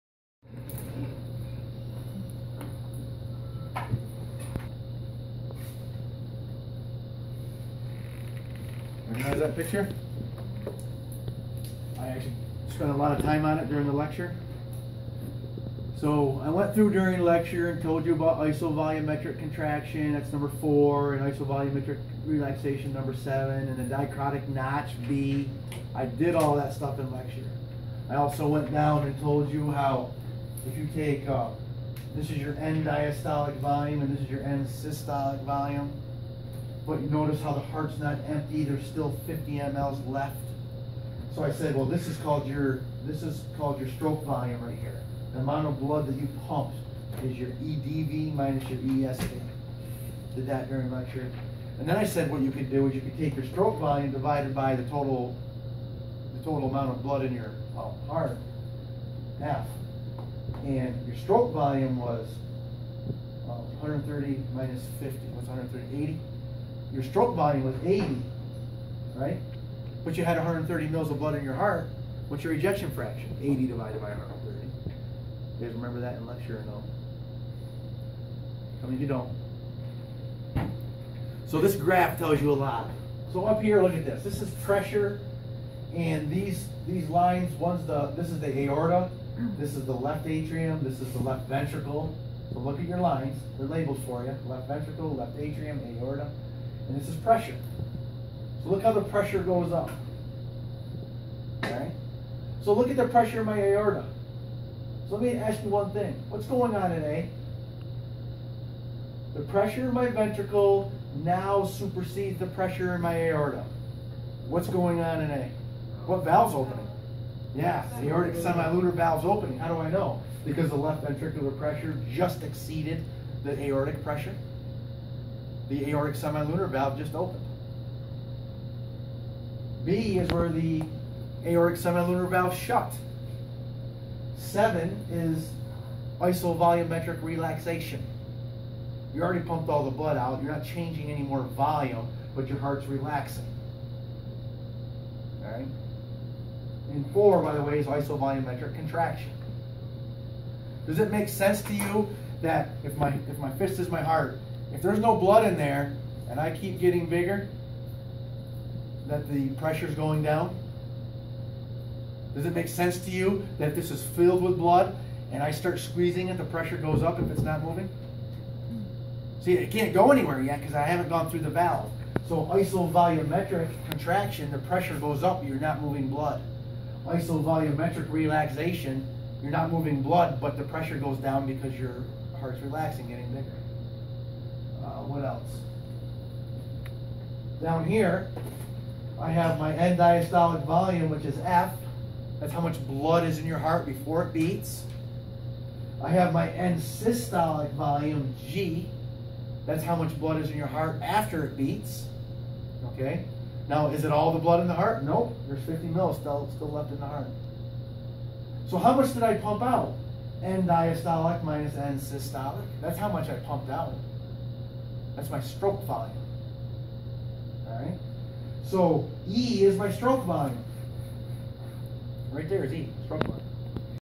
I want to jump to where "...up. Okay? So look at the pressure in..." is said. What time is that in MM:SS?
01:39.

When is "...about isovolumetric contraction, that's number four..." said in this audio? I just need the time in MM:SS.
00:18.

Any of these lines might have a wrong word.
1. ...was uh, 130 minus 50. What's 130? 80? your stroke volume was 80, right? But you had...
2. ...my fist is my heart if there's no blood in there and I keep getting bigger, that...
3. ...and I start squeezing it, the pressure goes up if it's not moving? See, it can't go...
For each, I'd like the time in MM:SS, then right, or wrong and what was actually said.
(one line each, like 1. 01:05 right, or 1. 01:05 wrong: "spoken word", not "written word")
1. 01:01 right
2. 02:33 right
3. 02:45 right.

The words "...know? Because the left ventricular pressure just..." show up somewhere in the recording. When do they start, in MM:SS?
01:59.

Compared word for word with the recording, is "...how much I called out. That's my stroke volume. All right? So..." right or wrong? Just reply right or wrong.
wrong.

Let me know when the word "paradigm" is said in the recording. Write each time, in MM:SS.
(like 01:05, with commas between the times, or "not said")
not said.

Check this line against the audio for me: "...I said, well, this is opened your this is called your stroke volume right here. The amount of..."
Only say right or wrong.
wrong.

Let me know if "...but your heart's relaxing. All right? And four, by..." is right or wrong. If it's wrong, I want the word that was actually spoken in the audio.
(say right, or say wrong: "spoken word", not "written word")
right.